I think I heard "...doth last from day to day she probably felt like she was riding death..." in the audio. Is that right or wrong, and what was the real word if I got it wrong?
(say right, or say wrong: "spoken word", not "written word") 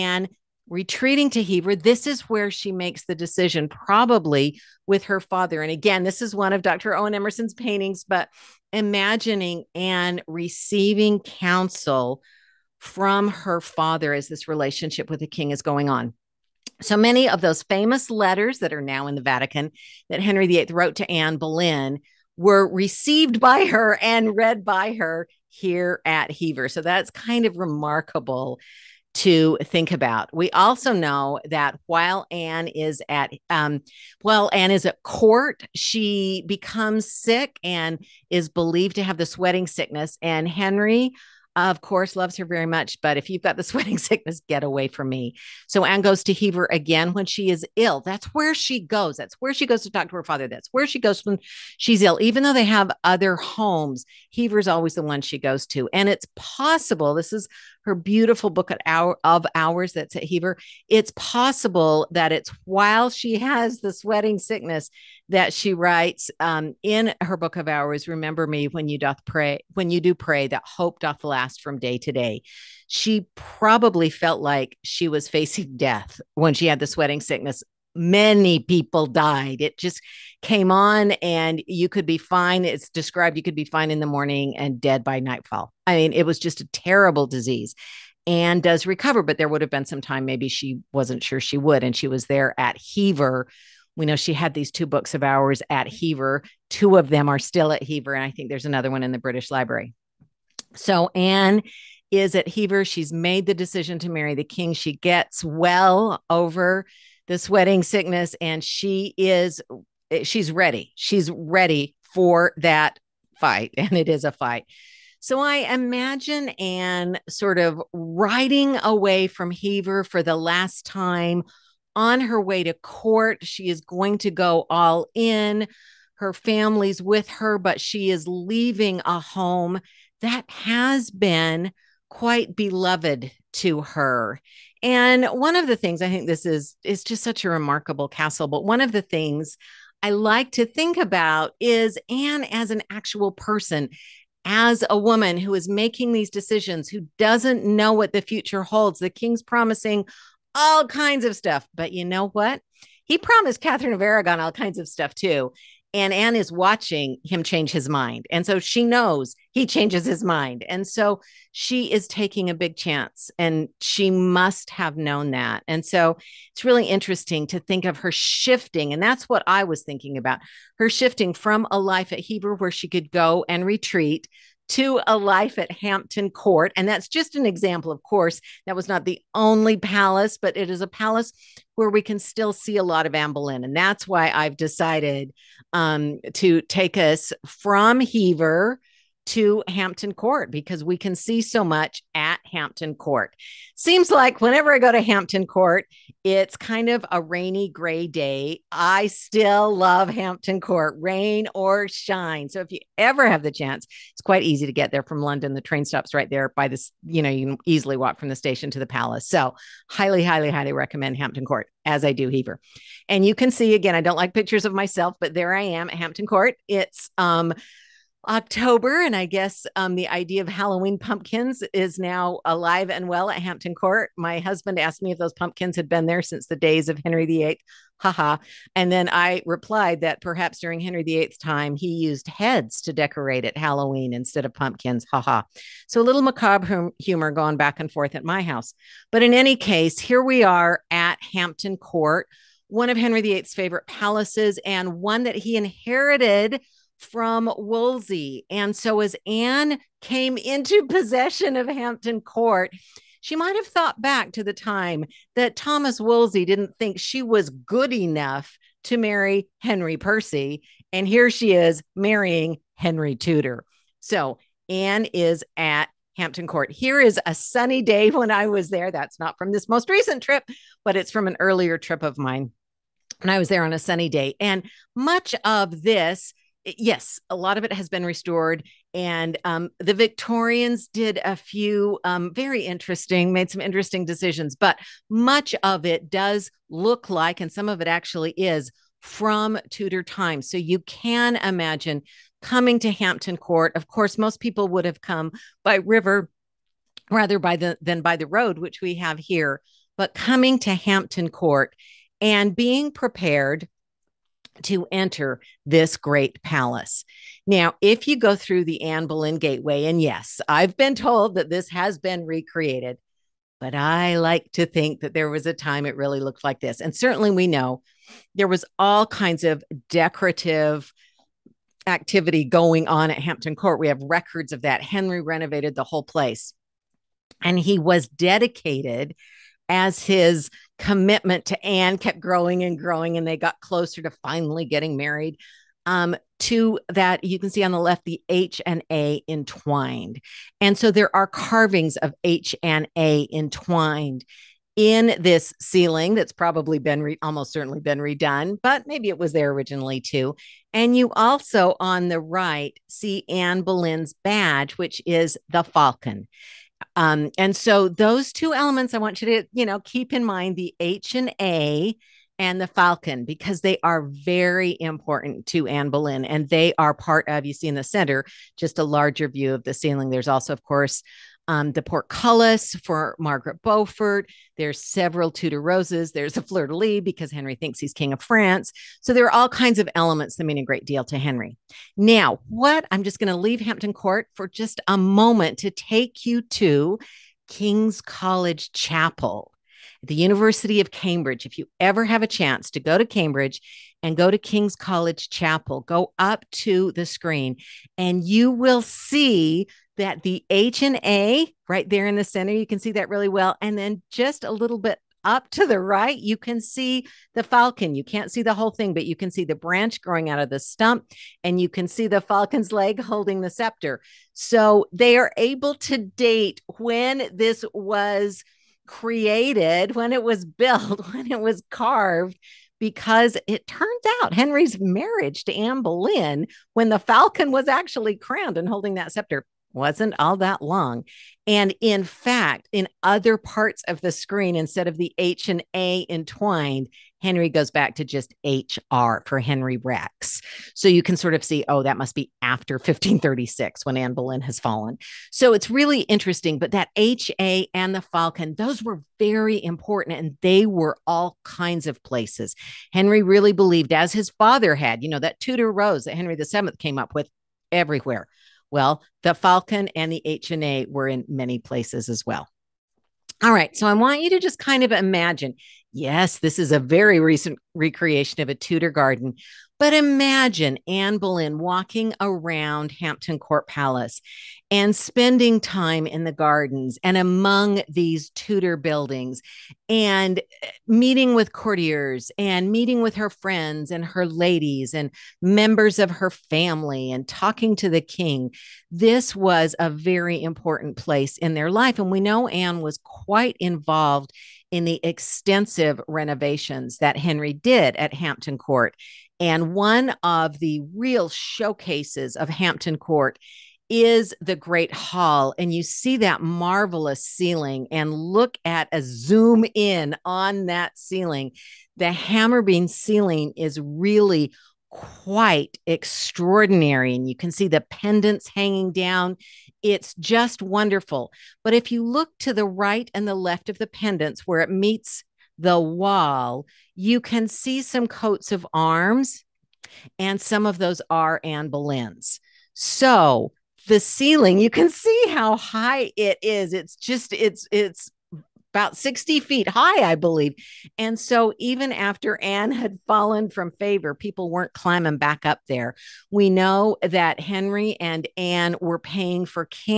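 wrong: "facing", not "riding".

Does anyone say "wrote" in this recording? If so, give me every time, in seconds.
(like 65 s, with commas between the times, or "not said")
20 s.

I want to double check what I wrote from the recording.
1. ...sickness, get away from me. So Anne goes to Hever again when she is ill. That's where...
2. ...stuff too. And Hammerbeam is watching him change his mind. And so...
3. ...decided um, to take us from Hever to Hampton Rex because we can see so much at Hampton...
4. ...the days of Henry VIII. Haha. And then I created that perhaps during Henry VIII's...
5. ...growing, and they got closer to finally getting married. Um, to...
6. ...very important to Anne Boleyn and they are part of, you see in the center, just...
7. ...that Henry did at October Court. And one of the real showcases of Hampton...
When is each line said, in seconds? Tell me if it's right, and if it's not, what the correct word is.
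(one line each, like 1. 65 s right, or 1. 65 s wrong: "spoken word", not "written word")
1. 43 s right
2. 154 s wrong: "Anne", not "Hammerbeam"
3. 184 s wrong: "Court", not "Rex"
4. 226 s wrong: "replied", not "created"
5. 332 s right
6. 364 s right
7. 496 s wrong: "Hampton", not "October".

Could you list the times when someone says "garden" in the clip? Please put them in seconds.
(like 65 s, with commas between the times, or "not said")
468 s, 476 s.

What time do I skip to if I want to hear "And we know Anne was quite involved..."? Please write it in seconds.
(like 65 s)
491 s.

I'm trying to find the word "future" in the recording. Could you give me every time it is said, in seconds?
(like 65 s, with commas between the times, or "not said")
148 s.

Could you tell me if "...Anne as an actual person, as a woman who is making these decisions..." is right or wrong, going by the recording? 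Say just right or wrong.
right.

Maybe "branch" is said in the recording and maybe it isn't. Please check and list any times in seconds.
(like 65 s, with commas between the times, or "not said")
409 s.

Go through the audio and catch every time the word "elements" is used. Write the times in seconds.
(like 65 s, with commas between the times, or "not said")
358 s, 379 s.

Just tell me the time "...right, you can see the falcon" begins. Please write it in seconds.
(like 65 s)
405 s.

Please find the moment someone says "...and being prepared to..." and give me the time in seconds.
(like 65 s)
302 s.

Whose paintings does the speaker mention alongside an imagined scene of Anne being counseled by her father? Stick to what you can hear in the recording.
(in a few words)
Dr. Owen Emmerson.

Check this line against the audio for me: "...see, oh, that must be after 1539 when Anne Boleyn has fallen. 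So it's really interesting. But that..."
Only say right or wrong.
wrong.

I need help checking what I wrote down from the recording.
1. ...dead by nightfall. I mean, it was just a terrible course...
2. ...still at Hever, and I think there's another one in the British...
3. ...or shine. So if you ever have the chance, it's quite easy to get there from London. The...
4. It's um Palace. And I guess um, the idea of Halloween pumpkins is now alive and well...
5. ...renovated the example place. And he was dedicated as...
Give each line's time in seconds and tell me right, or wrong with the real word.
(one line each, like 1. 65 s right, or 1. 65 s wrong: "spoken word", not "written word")
1. 84 s wrong: "disease", not "course"
2. 97 s right
3. 201 s right
4. 216 s wrong: "October", not "Palace"
5. 325 s wrong: "whole", not "example".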